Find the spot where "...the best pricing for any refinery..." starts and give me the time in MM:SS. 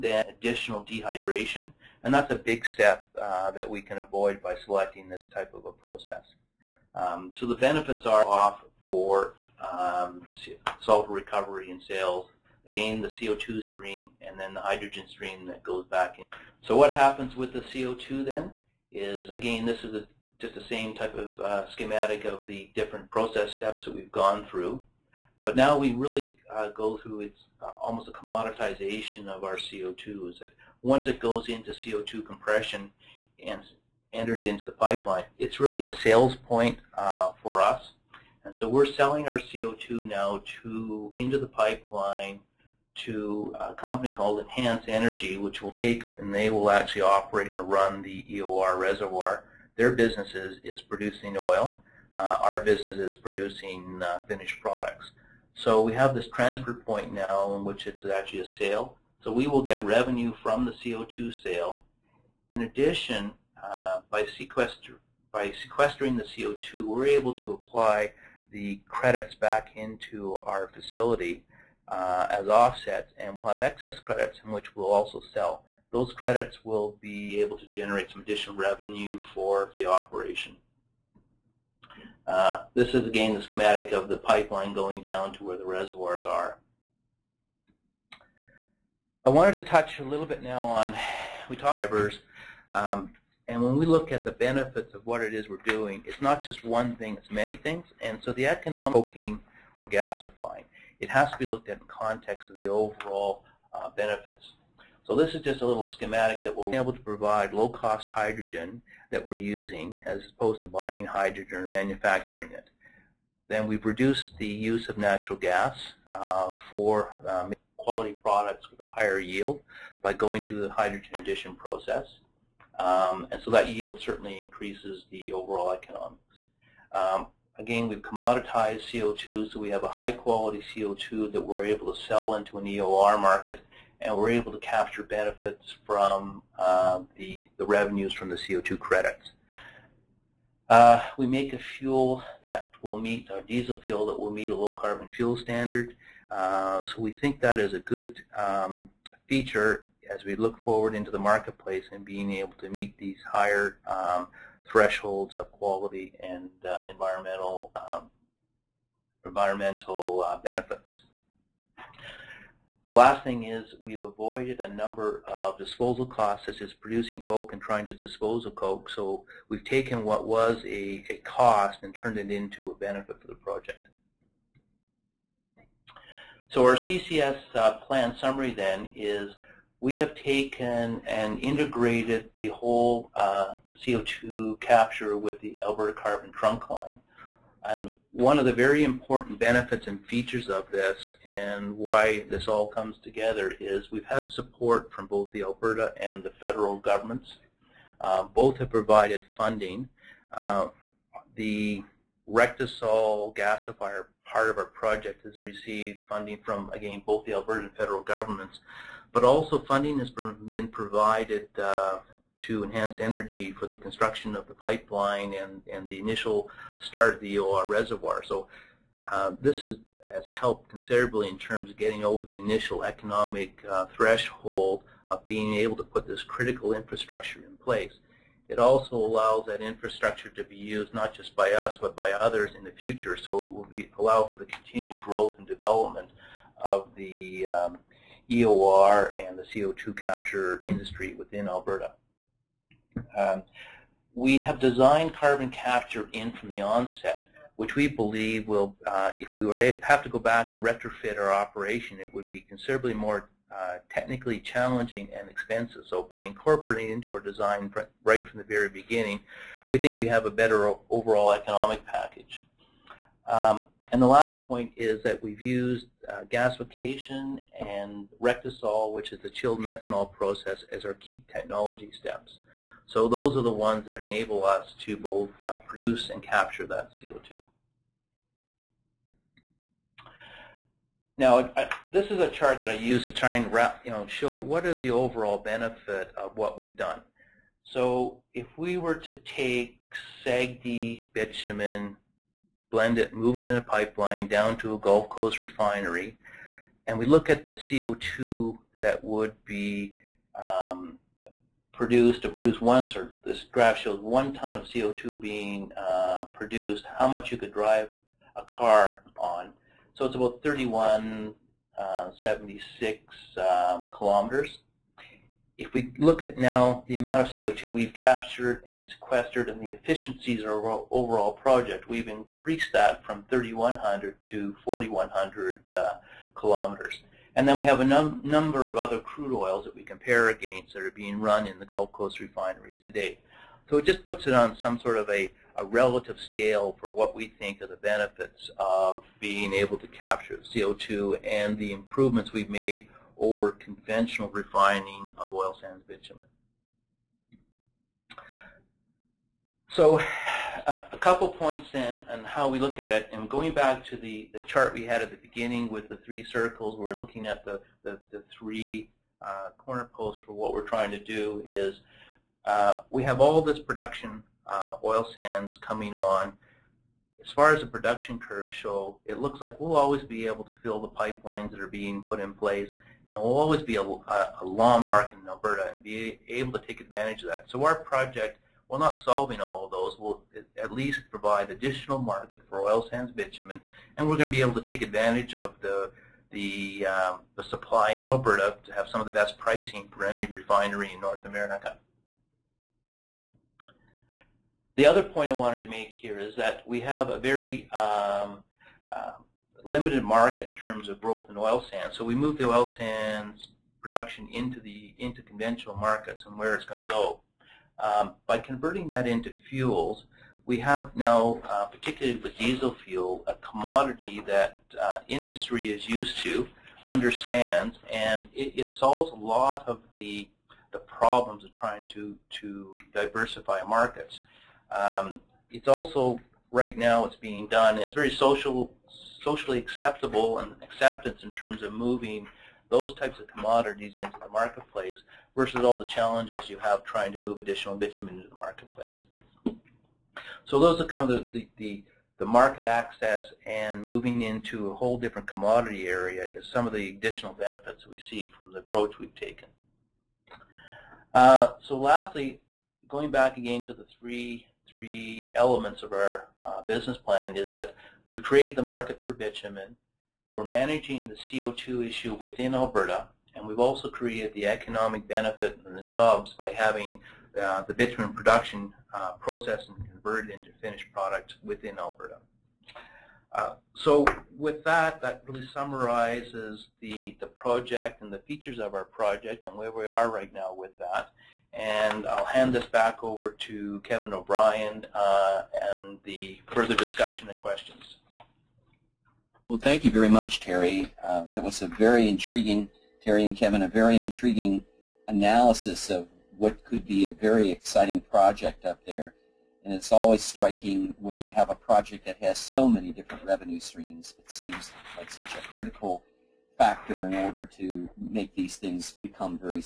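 06:29.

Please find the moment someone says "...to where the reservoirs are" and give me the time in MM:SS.
01:25.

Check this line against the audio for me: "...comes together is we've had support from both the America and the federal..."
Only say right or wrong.
wrong.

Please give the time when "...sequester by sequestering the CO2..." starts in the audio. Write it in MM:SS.
01:04.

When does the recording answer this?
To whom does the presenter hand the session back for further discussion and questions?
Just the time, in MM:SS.
08:03.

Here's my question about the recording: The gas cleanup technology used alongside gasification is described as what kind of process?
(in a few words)
chilled methanol.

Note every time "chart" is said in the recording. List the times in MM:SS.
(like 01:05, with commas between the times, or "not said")
04:42, 05:54.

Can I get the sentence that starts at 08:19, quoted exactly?
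And it's always striking when you have a project that has so many different revenue streams.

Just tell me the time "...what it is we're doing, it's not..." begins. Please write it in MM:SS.
01:35.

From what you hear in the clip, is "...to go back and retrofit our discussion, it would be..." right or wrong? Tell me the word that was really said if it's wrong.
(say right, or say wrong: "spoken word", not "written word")
wrong: "operation", not "discussion".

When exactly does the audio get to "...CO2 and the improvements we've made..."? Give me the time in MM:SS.
05:40.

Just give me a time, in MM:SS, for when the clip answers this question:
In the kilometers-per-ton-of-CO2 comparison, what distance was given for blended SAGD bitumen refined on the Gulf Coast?
05:10.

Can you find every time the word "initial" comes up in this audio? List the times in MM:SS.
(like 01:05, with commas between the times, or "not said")
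03:35, 03:42.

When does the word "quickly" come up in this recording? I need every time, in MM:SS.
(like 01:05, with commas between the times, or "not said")
not said.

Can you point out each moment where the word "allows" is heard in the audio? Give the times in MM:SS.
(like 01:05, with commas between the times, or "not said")
03:48, 03:53.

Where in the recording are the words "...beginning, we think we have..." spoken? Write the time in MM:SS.
04:18.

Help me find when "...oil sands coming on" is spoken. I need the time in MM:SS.
06:04.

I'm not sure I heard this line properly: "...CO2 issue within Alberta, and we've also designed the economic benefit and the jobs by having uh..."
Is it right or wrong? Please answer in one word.
wrong.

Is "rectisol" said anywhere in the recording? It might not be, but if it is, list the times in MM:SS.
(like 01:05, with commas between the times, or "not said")
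03:22, 04:28.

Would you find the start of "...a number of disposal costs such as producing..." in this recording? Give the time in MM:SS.
02:44.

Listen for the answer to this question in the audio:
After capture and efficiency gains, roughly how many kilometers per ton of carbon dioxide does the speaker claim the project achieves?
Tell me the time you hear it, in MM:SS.
05:24.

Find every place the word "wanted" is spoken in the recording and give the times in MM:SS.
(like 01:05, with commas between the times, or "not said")
01:29, 06:35.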